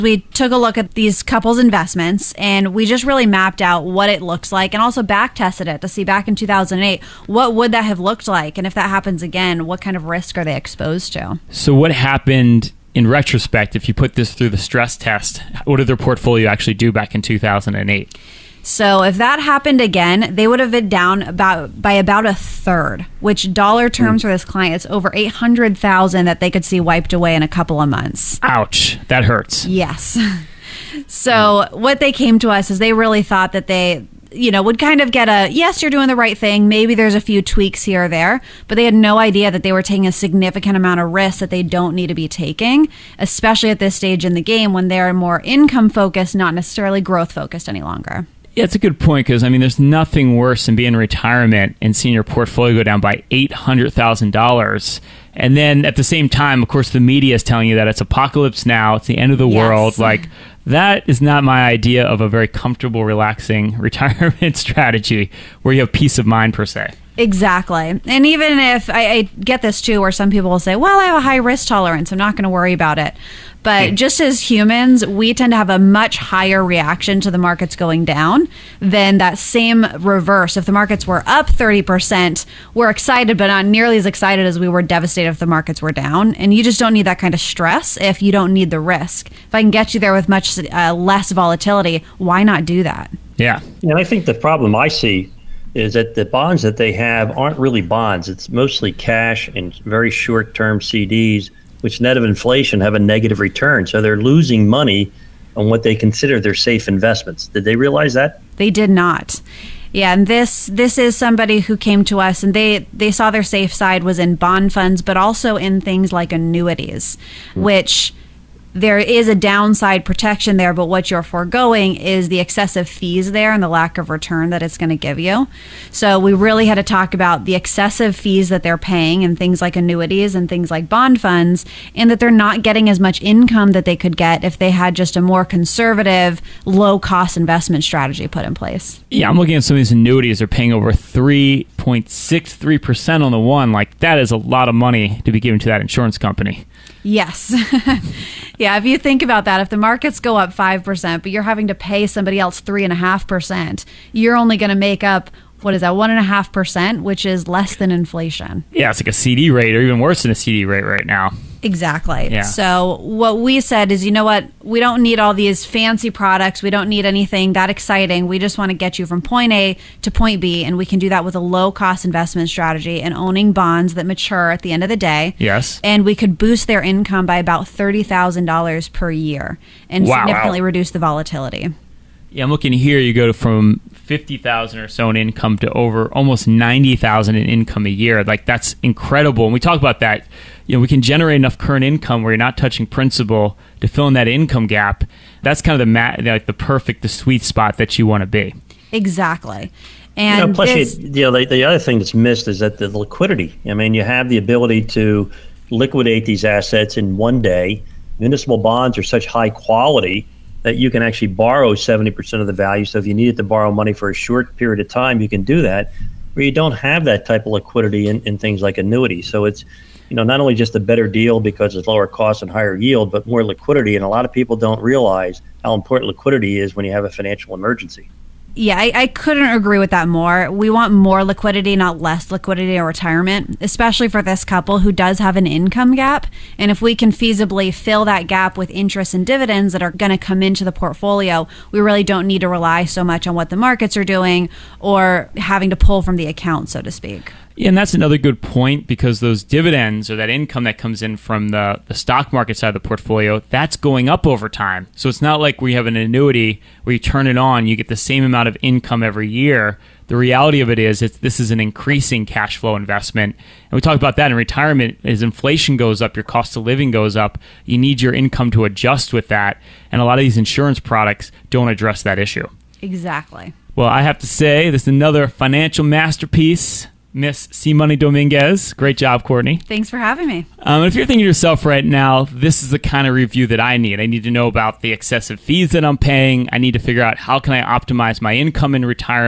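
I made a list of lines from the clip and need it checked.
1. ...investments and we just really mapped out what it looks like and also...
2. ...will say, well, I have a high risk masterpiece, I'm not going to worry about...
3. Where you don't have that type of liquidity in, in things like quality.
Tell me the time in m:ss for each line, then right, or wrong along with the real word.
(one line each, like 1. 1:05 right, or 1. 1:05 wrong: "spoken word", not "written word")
1. 0:01 right
2. 1:10 wrong: "tolerance", not "masterpiece"
3. 3:36 wrong: "annuity", not "quality".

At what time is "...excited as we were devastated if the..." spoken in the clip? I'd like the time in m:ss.
1:24.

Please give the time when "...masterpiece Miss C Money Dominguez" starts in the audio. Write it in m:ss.
4:35.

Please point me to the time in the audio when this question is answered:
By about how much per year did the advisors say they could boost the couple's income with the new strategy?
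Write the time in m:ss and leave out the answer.
2:57.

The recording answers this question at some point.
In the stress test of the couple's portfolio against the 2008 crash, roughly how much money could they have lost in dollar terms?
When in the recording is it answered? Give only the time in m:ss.
0:24.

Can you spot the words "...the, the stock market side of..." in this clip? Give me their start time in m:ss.
4:11.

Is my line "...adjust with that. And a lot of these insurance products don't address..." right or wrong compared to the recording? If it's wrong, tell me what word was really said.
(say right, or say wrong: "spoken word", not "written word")
right.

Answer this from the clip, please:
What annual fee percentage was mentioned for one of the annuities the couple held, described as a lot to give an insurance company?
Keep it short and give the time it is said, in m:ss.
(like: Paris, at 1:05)
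3.63%, at 2:20.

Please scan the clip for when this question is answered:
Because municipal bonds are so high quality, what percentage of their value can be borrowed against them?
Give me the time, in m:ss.
3:31.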